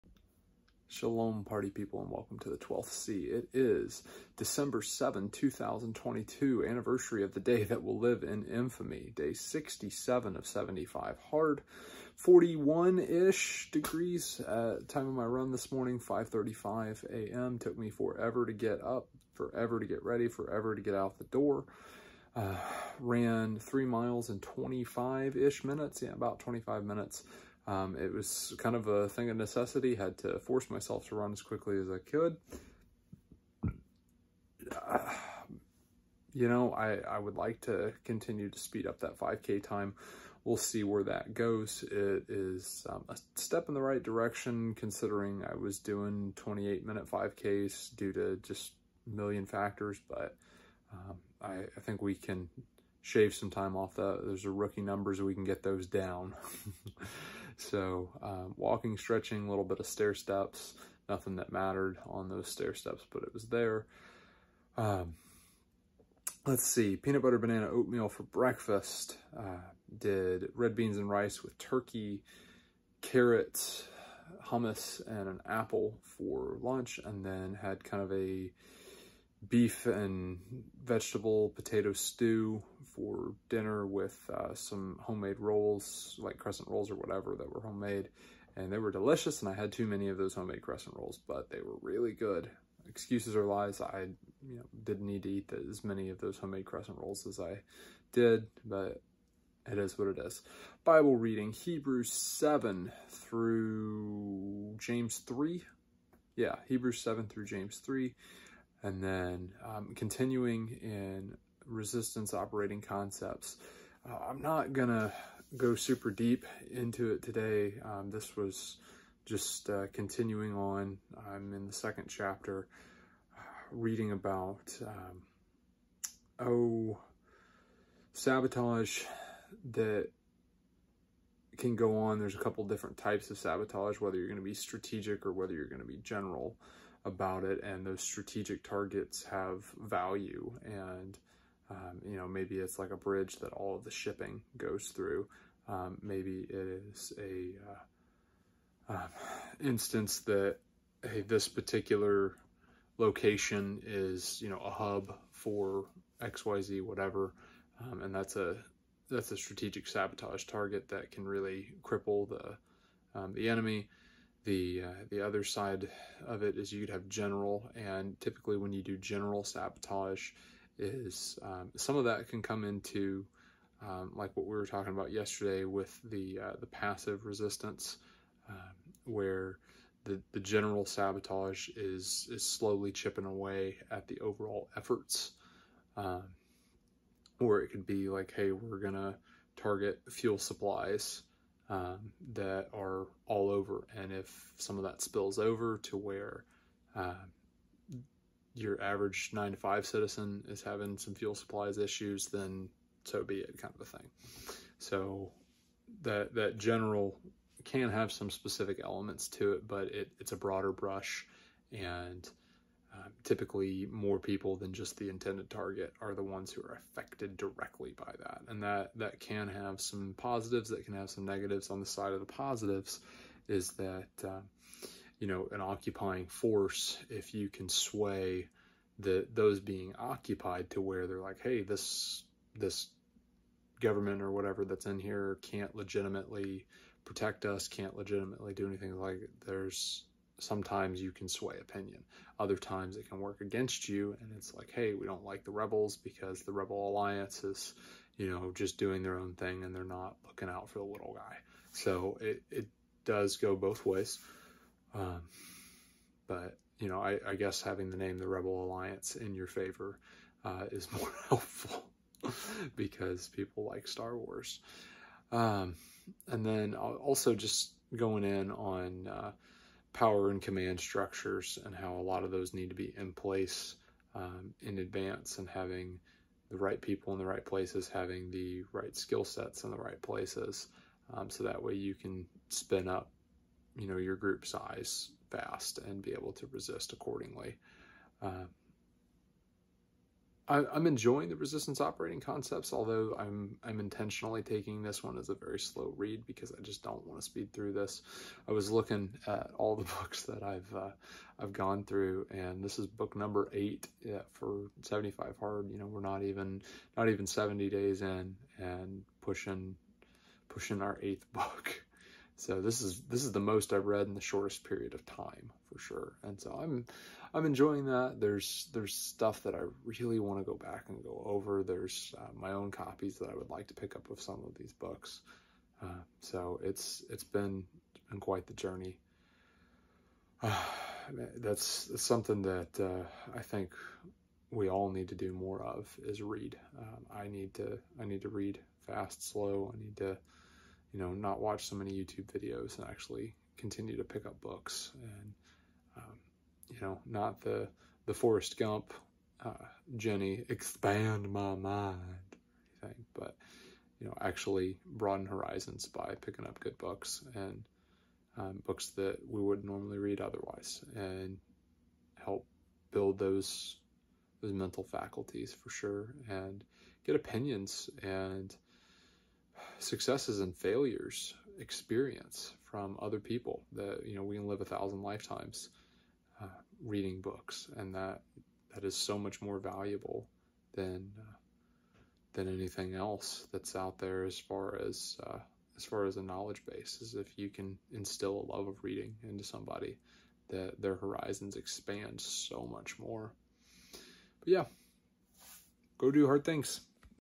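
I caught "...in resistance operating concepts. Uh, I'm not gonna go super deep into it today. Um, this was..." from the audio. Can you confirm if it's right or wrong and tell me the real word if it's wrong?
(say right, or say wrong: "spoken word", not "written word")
right.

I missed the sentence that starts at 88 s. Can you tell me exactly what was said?
And they were delicious, and I had too many of those homemade crescent rolls, but they were really good.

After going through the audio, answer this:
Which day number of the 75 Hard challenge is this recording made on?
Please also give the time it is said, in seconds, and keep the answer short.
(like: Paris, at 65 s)
67, at 9 s.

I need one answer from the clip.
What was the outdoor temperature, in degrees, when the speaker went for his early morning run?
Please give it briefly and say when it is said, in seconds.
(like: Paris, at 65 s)
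41, at 12 s.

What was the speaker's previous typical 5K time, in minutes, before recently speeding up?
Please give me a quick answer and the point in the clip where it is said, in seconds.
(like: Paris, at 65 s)
28 minutes, at 46 s.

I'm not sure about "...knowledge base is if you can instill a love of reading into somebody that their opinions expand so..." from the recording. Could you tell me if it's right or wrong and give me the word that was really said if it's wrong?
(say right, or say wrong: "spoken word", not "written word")
wrong: "horizons", not "opinions".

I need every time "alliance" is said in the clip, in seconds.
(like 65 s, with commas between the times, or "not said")
246 s, 258 s.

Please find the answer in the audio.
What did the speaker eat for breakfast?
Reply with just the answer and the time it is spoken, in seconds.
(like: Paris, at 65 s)
Peanut butter banana oatmeal, at 66 s.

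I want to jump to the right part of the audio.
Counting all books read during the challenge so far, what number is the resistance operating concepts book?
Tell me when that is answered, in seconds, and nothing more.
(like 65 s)
302 s.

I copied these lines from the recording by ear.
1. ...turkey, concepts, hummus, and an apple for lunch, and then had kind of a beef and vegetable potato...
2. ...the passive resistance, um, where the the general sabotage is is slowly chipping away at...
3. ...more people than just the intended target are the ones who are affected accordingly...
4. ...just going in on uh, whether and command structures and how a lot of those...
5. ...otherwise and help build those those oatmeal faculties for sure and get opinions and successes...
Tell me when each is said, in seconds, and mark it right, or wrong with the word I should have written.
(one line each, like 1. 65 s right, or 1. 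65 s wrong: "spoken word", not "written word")
1. 71 s wrong: "carrots", not "concepts"
2. 176 s right
3. 213 s wrong: "directly", not "accordingly"
4. 267 s wrong: "power", not "whether"
5. 360 s wrong: "mental", not "oatmeal".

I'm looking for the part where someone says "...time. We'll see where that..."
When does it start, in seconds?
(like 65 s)
39 s.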